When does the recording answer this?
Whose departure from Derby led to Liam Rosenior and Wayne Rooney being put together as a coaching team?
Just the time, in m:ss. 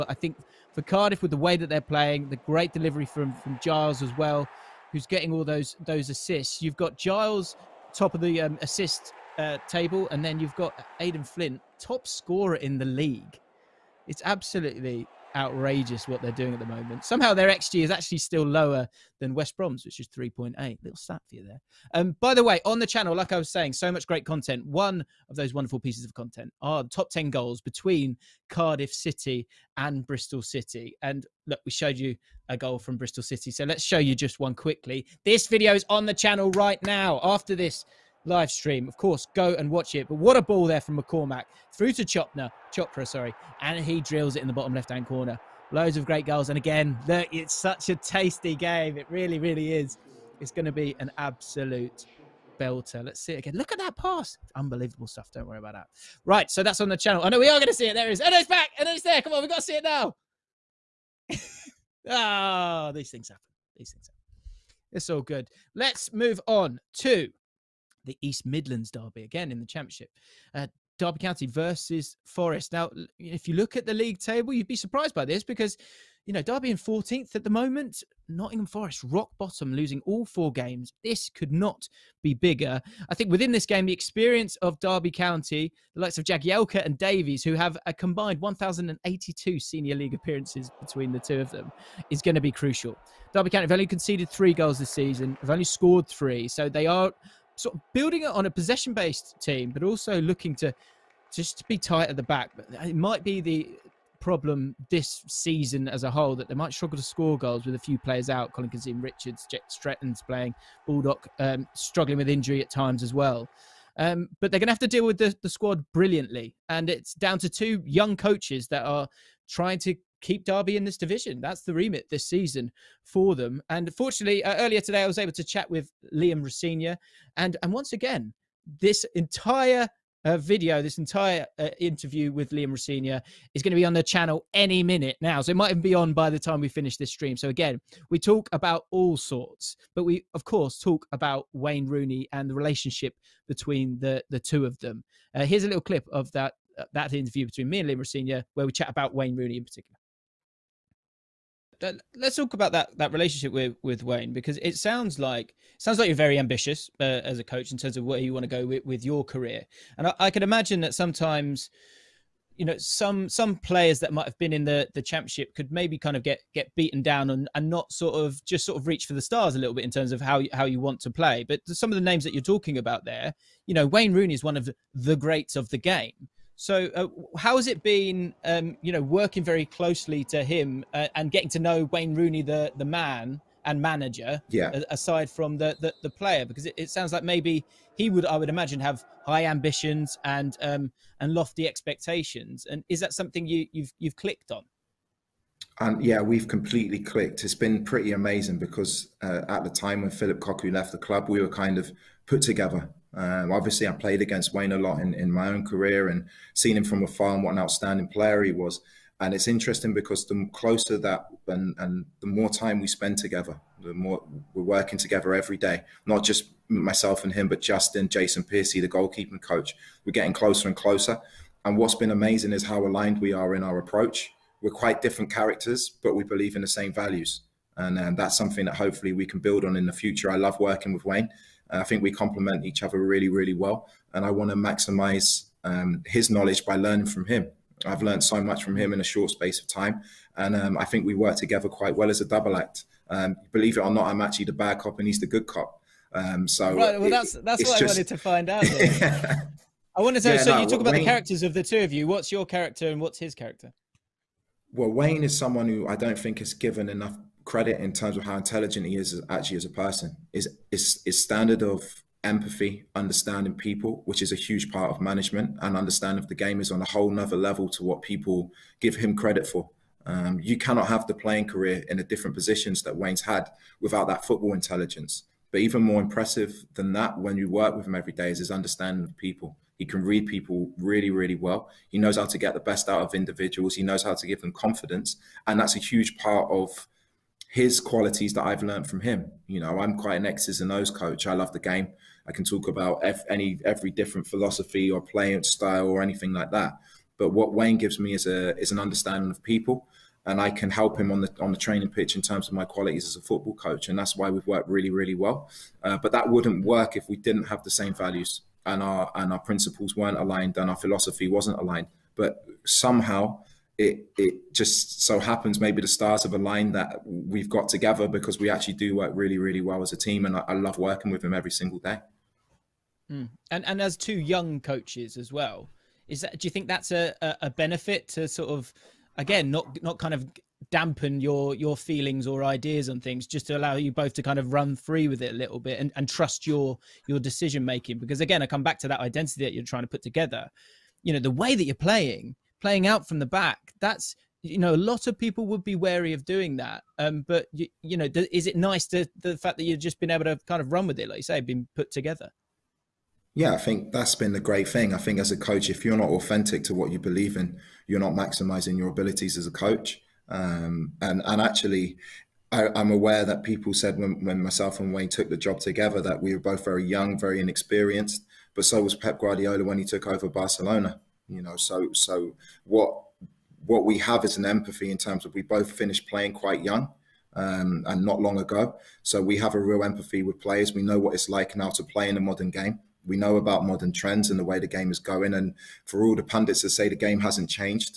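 3:20.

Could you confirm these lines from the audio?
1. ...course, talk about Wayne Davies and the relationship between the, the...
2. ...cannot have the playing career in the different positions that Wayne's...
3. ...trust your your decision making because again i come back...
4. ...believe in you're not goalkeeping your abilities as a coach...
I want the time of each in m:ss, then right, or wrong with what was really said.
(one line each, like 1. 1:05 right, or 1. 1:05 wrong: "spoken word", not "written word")
1. 2:20 wrong: "Rooney", not "Davies"
2. 4:30 right
3. 5:36 right
4. 5:56 wrong: "maximizing", not "goalkeeping".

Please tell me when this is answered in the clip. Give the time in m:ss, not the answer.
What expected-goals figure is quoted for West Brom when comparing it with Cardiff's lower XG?
0:20.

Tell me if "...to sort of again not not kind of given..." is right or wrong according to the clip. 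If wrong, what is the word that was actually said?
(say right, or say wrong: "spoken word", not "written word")
wrong: "dampen", not "given".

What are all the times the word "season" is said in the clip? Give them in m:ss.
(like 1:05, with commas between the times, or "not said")
1:34, 1:45, 2:02.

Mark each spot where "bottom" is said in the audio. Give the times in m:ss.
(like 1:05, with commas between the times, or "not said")
0:44, 1:19.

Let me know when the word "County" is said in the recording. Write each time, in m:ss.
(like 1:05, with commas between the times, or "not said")
1:11, 1:25, 1:33.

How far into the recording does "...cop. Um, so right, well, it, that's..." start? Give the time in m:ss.
4:05.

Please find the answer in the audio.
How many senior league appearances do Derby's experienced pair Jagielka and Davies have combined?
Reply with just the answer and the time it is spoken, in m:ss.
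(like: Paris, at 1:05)
1,082, at 1:28.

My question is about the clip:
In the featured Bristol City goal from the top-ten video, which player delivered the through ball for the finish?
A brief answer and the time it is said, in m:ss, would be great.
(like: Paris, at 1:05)
McCormack, at 0:41.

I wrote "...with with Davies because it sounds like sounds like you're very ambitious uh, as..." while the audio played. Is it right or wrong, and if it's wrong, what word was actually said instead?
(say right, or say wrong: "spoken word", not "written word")
wrong: "Wayne", not "Davies".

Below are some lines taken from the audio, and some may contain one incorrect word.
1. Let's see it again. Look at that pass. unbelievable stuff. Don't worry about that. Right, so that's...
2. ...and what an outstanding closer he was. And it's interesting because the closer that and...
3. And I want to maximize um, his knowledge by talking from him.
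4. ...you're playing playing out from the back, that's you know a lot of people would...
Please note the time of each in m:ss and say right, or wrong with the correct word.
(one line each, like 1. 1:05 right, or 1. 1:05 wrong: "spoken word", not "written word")
1. 0:53 right
2. 3:27 wrong: "player", not "closer"
3. 3:54 wrong: "learning", not "talking"
4. 5:41 right.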